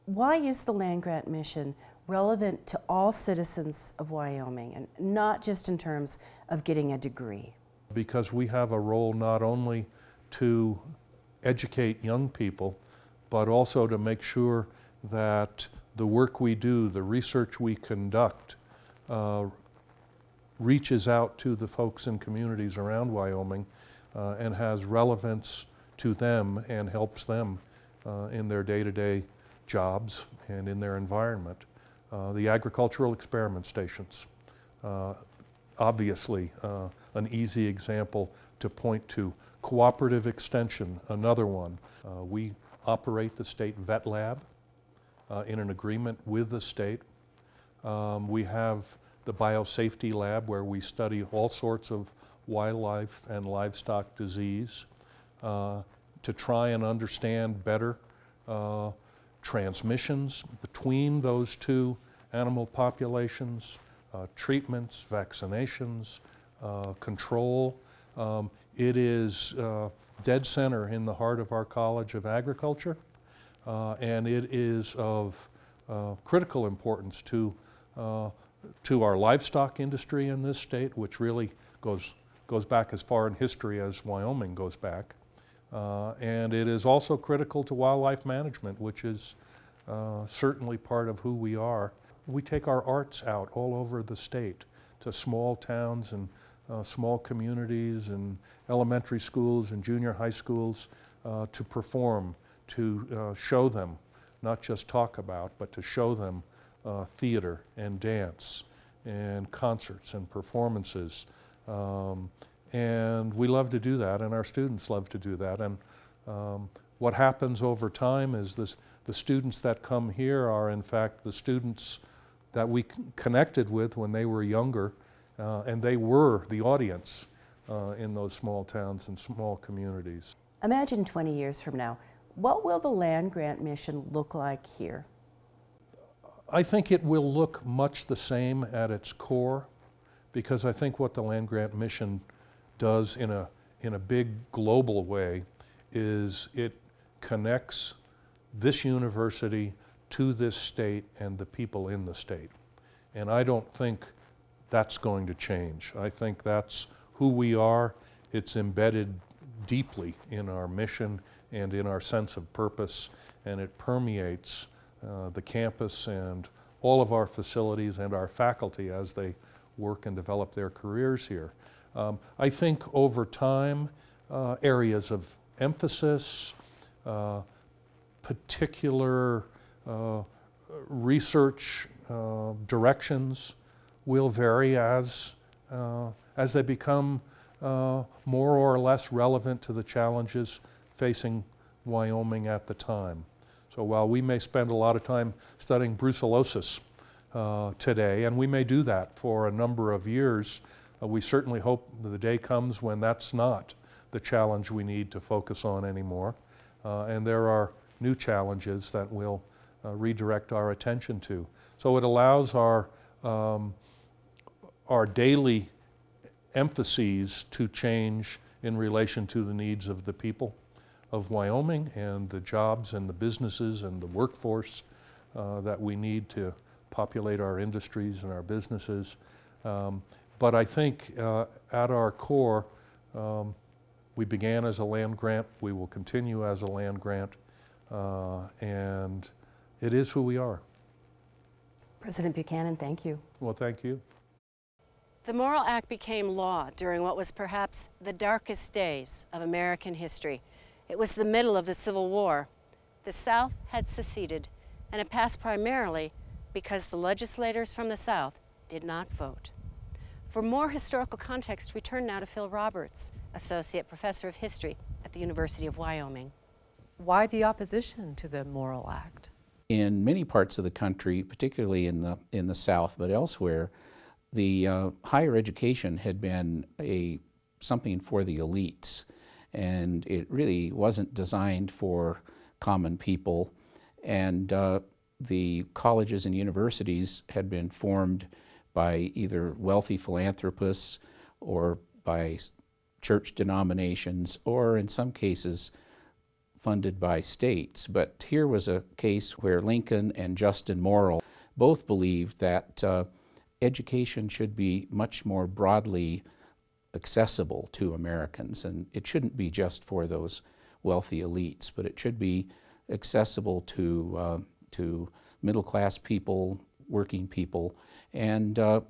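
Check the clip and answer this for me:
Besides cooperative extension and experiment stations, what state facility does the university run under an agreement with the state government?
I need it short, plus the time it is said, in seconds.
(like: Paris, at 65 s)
state vet lab, at 43 s.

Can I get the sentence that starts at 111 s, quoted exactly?
Um, and we love to do that, and our students love to do that.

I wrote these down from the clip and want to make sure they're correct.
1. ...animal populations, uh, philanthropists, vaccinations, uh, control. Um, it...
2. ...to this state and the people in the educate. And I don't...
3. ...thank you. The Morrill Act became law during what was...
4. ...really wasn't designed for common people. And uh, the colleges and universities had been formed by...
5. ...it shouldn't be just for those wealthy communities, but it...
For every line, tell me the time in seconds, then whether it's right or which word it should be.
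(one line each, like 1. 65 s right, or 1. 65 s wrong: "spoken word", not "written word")
1. 62 s wrong: "treatments", not "philanthropists"
2. 150 s wrong: "state", not "educate"
3. 243 s right
4. 280 s right
5. 308 s wrong: "elites", not "communities".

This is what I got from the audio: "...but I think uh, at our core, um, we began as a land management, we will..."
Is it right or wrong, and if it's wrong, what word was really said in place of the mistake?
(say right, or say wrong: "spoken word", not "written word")
wrong: "grant", not "management".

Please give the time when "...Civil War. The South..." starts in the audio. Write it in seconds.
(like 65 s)
251 s.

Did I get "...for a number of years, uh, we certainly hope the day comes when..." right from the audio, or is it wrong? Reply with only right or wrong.
right.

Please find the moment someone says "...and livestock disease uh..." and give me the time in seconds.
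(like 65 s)
53 s.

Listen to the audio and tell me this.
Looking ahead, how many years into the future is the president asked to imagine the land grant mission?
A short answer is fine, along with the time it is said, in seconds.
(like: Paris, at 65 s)
20, at 131 s.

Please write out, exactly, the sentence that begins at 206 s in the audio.
Uh, and there are new challenges that we'll uh, redirect our attention to.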